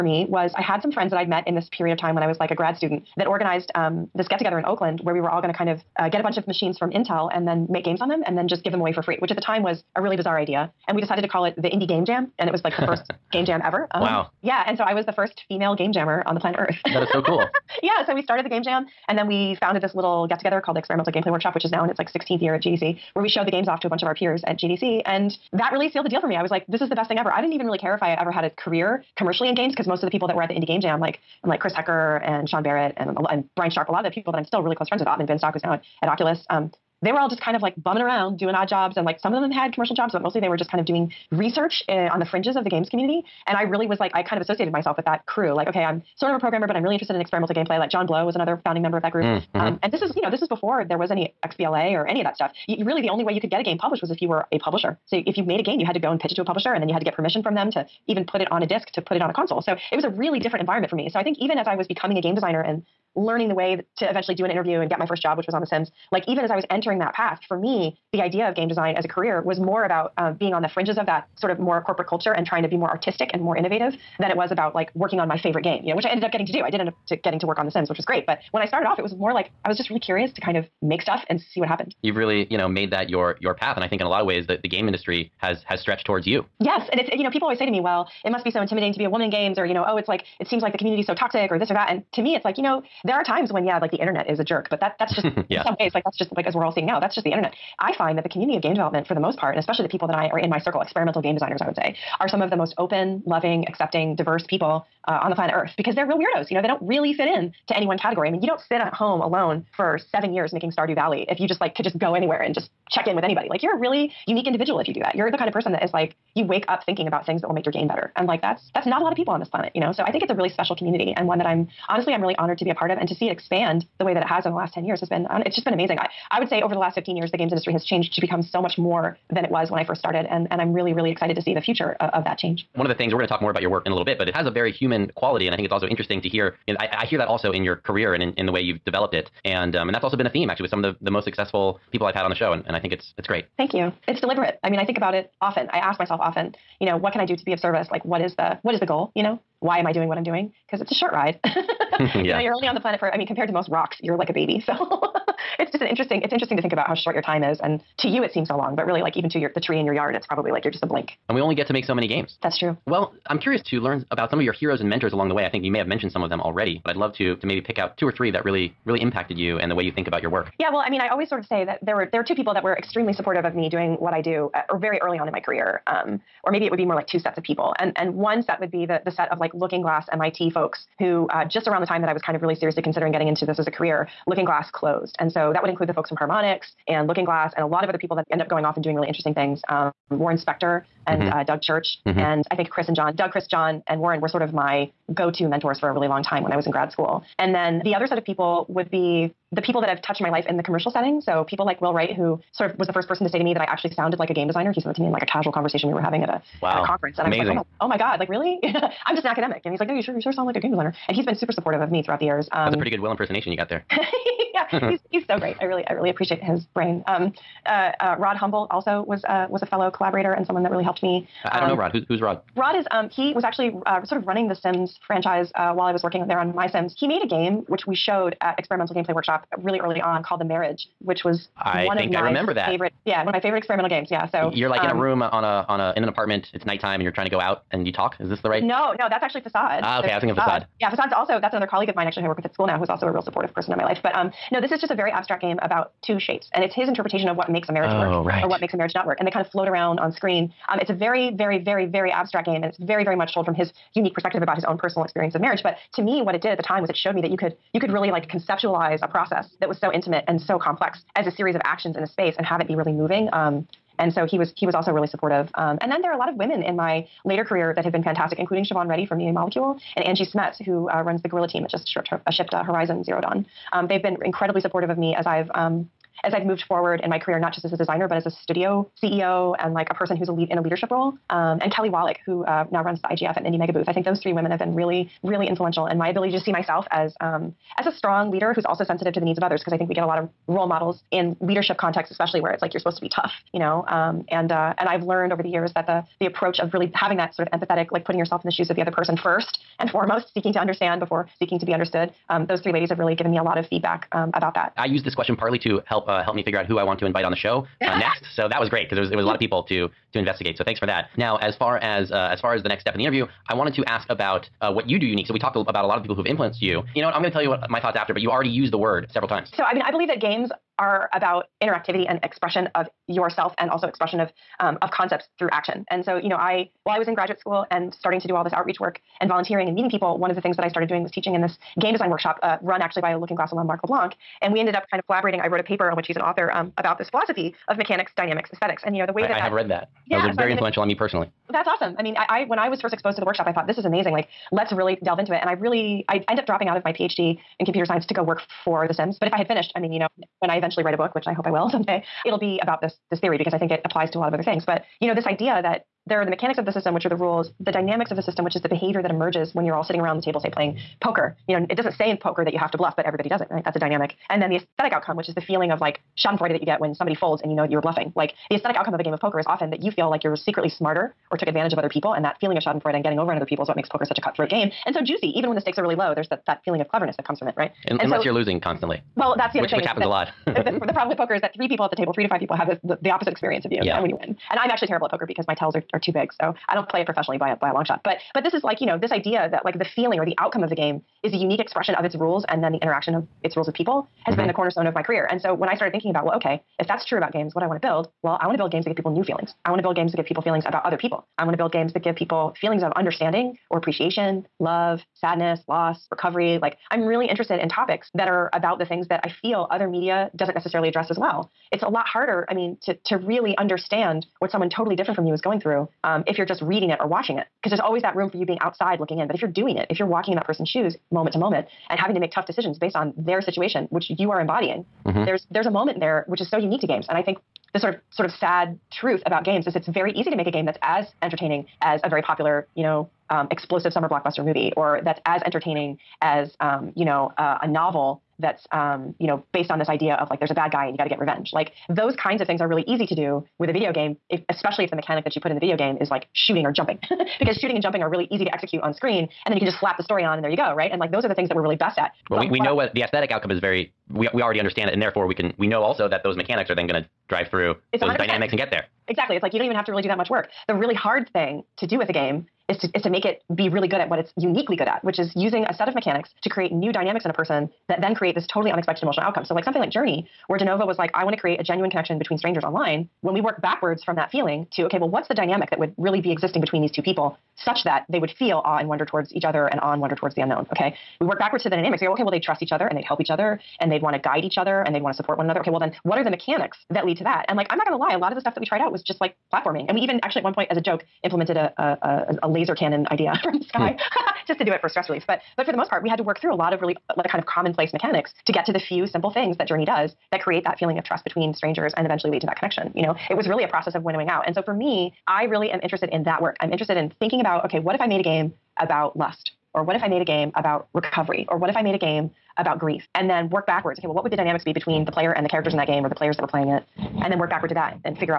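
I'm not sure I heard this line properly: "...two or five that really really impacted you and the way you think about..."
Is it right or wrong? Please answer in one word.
wrong.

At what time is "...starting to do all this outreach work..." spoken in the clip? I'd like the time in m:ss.
5:28.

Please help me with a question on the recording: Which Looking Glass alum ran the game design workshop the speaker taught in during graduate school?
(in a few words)
Marc LeBlanc.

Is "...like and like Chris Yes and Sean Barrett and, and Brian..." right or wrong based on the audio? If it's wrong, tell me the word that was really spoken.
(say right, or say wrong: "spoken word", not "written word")
wrong: "Hecker", not "Yes".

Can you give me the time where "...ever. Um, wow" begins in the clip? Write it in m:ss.
0:13.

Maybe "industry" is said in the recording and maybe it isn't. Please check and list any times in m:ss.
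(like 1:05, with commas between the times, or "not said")
1:24, 2:07.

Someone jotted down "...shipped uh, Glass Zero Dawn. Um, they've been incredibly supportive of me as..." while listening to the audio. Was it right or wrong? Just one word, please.
wrong.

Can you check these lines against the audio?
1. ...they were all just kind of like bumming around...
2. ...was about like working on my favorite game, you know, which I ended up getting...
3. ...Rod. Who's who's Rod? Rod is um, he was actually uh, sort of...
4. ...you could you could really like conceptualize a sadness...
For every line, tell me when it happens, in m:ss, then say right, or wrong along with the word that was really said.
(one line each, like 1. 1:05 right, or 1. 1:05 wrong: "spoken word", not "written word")
1. 0:37 right
2. 1:14 right
3. 3:41 right
4. 4:17 wrong: "process", not "sadness".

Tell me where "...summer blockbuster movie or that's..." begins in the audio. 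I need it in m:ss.
7:13.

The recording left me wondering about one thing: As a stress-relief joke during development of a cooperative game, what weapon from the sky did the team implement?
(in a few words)
laser cannon.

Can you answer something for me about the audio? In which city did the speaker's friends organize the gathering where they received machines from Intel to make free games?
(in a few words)
Oakland.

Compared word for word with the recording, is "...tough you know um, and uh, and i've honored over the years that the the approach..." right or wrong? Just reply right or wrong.
wrong.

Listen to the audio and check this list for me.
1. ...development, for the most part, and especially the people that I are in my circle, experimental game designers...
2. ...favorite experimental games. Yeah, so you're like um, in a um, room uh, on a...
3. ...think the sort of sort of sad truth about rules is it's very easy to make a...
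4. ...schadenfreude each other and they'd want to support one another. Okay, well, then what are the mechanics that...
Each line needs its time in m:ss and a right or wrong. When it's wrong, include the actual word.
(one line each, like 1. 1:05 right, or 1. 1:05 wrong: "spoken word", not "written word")
1. 1:38 right
2. 3:53 right
3. 7:07 wrong: "games", not "rules"
4. 8:04 wrong: "guide", not "schadenfreude".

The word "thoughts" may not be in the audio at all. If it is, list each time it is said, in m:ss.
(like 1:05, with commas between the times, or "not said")
5:17, 5:43.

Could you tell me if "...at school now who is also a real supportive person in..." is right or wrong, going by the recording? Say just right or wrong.
right.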